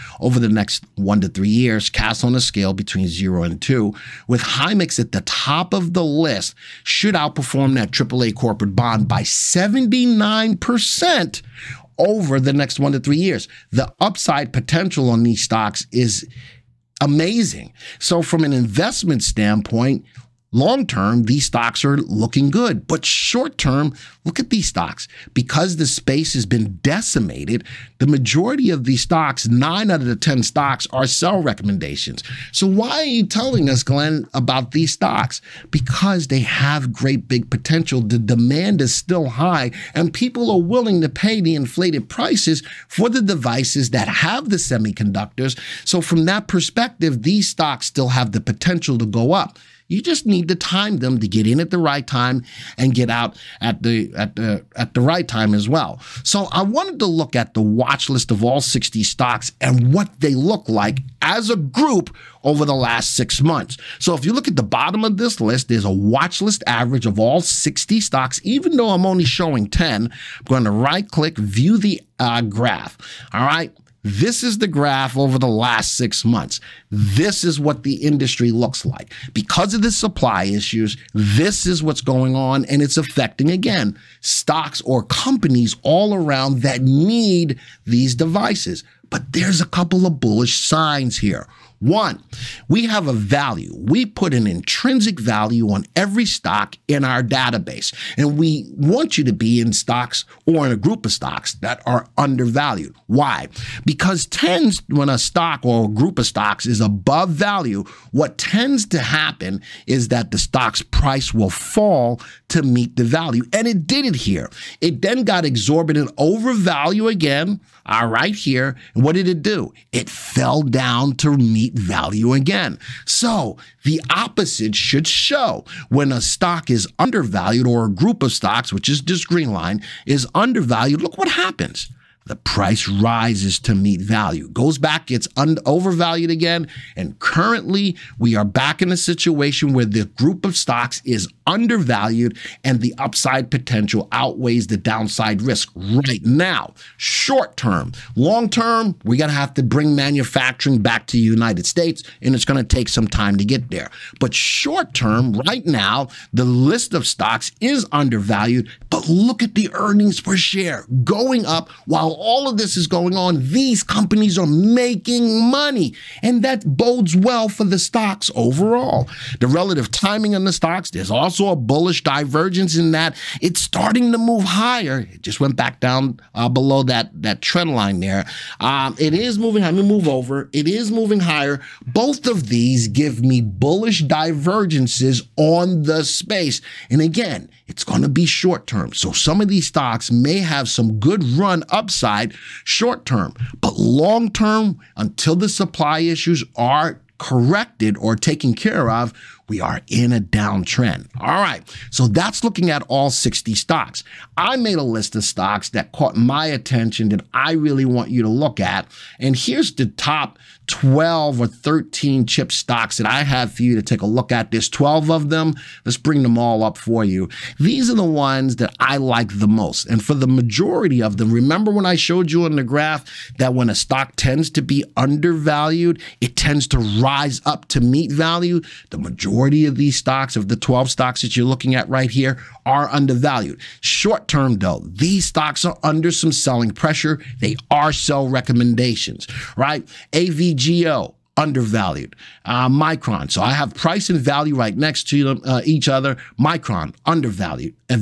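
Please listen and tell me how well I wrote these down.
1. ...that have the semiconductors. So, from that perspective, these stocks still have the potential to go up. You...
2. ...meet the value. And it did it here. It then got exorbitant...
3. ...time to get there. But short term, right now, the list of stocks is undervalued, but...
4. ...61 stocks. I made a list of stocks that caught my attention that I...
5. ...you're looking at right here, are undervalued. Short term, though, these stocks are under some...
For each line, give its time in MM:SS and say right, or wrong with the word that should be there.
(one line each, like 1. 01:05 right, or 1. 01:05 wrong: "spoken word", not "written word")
1. 00:43 right
2. 01:52 right
3. 02:33 right
4. 03:23 wrong: "60", not "61"
5. 03:51 right.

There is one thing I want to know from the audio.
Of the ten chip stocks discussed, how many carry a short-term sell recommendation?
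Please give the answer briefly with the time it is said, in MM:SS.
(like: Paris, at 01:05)
9, at 00:29.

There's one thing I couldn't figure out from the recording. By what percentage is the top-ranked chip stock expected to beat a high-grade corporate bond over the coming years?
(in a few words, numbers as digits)
79%.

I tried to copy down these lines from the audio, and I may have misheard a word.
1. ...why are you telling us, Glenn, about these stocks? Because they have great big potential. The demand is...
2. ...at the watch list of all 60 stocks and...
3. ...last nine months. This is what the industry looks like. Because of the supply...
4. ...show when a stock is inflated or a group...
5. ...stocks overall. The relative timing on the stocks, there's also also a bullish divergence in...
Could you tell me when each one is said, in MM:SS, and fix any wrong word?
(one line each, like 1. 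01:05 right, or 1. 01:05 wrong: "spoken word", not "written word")
1. 00:32 right
2. 00:57 right
3. 01:15 wrong: "six", not "nine"
4. 02:05 wrong: "undervalued", not "inflated"
5. 02:47 right.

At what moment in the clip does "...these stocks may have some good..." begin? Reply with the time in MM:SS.
03:09.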